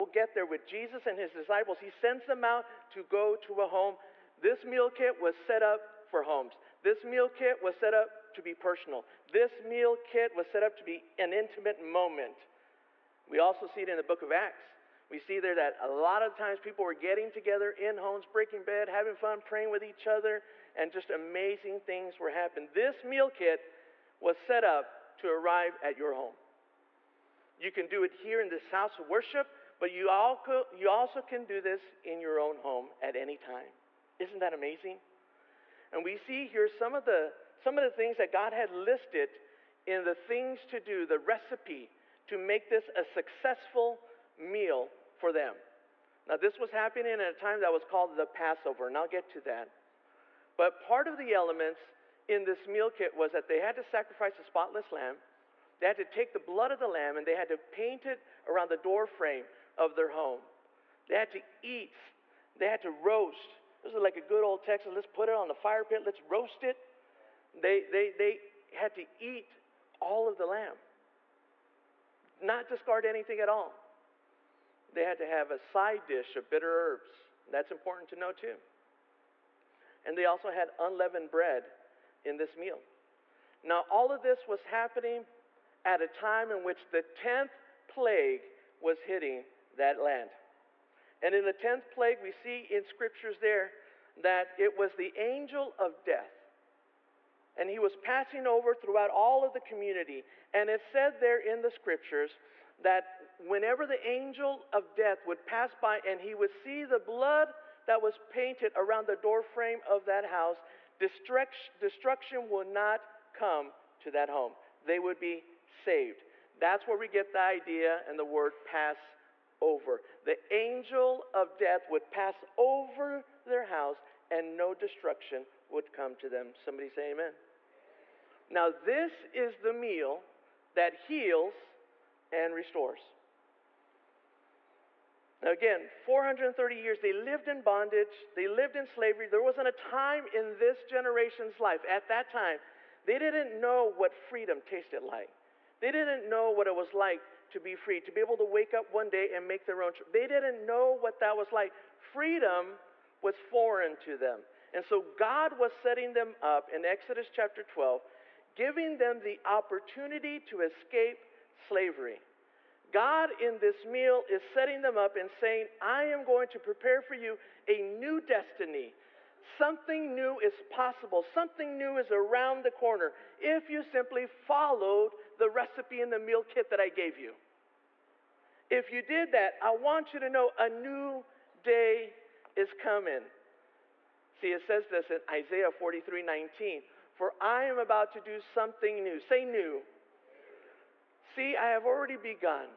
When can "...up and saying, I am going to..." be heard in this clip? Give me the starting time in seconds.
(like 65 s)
164 s.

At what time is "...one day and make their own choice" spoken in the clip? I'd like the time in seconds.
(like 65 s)
148 s.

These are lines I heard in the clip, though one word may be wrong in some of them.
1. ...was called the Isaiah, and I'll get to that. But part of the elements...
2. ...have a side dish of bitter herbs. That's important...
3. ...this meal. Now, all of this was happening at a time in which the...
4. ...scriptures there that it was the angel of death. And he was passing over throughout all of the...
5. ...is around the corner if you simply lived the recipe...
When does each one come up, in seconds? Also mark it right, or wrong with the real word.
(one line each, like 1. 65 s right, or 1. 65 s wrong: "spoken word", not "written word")
1. 47 s wrong: "Passover", not "Isaiah"
2. 75 s right
3. 82 s right
4. 92 s right
5. 171 s wrong: "followed", not "lived".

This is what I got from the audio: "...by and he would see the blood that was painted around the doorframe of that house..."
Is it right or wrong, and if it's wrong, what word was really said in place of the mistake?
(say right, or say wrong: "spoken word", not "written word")
right.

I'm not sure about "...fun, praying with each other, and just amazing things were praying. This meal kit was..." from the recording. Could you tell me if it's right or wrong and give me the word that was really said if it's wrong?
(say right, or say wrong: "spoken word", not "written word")
wrong: "happening", not "praying".